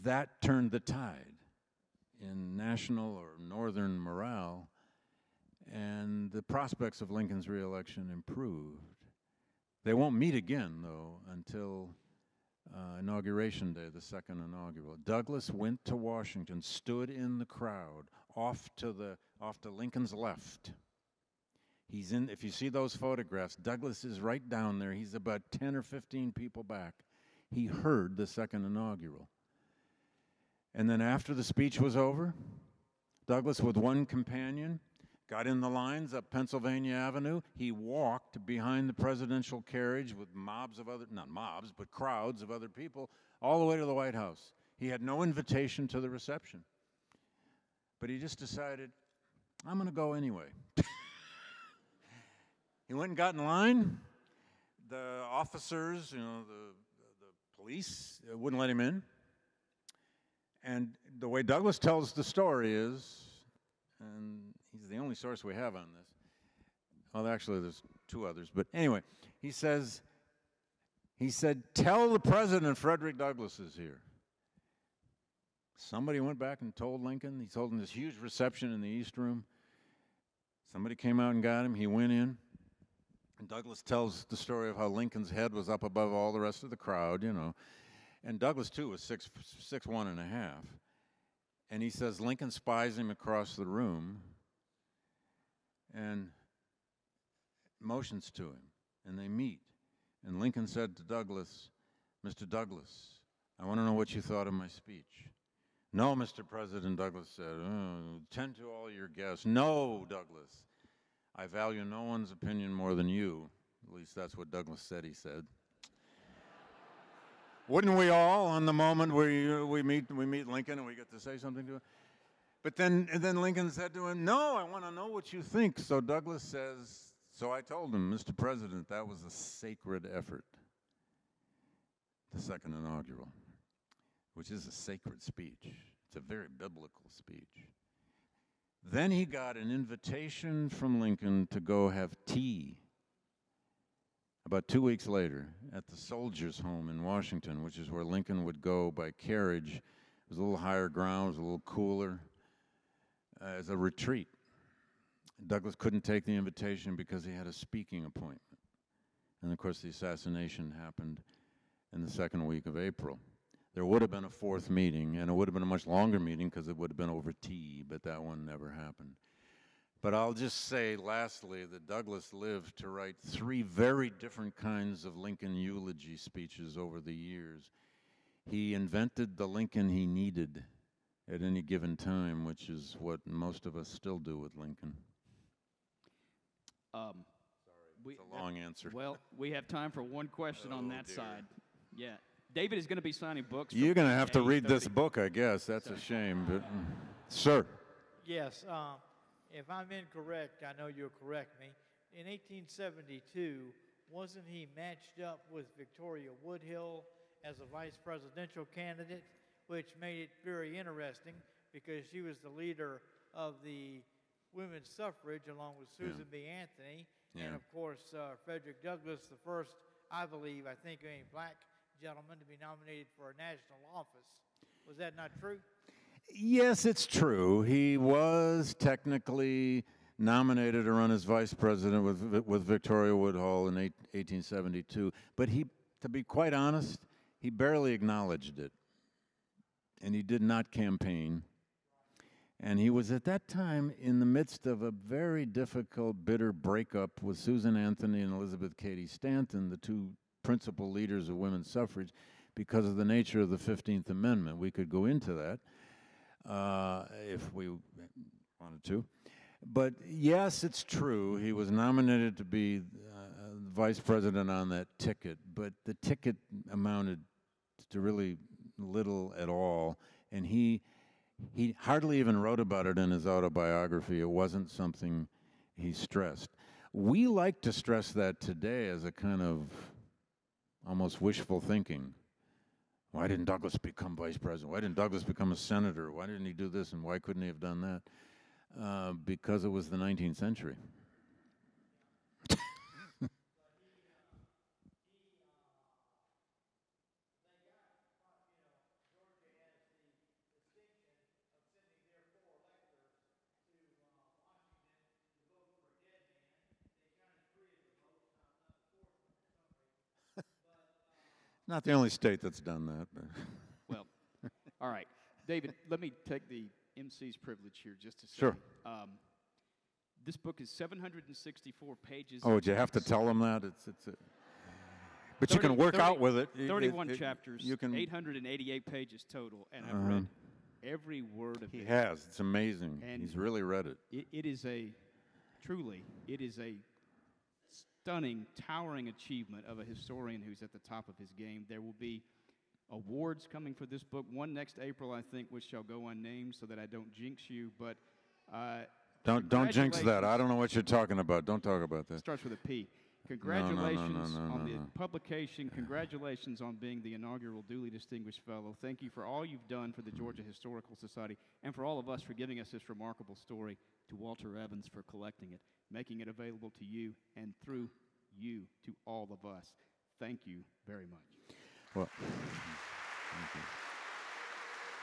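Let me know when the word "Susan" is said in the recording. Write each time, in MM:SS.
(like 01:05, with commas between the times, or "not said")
03:35, 04:07.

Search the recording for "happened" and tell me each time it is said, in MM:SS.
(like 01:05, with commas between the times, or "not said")
02:40, 02:48.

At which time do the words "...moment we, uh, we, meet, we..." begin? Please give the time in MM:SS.
01:58.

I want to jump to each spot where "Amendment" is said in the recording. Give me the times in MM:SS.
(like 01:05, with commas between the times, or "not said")
04:14.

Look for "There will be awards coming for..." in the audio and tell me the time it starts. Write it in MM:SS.
05:41.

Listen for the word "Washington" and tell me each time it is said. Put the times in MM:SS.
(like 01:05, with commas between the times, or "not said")
00:15, 02:27.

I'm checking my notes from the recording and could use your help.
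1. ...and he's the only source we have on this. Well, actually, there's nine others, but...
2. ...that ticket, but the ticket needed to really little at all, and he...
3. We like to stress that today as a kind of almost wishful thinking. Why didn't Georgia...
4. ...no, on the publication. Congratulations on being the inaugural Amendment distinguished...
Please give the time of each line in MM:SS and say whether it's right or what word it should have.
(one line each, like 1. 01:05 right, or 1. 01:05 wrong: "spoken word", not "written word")
1. 01:03 wrong: "two", not "nine"
2. 04:24 wrong: "amounted", not "needed"
3. 04:36 wrong: "Douglass", not "Georgia"
4. 05:54 wrong: "Dooley", not "Amendment".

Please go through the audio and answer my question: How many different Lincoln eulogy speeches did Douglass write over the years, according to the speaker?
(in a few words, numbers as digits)
3.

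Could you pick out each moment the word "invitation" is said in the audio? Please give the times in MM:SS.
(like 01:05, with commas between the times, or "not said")
00:45, 02:19, 02:36.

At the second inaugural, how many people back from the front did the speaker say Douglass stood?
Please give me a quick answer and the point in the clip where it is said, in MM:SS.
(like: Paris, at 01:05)
10 or 15, at 00:25.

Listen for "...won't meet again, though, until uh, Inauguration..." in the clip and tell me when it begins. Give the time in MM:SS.
00:09.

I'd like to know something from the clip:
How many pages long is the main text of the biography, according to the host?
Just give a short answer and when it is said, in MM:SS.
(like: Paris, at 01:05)
764, at 05:20.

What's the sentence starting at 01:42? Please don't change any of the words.
Douglass, I want to know what you thought of my speech.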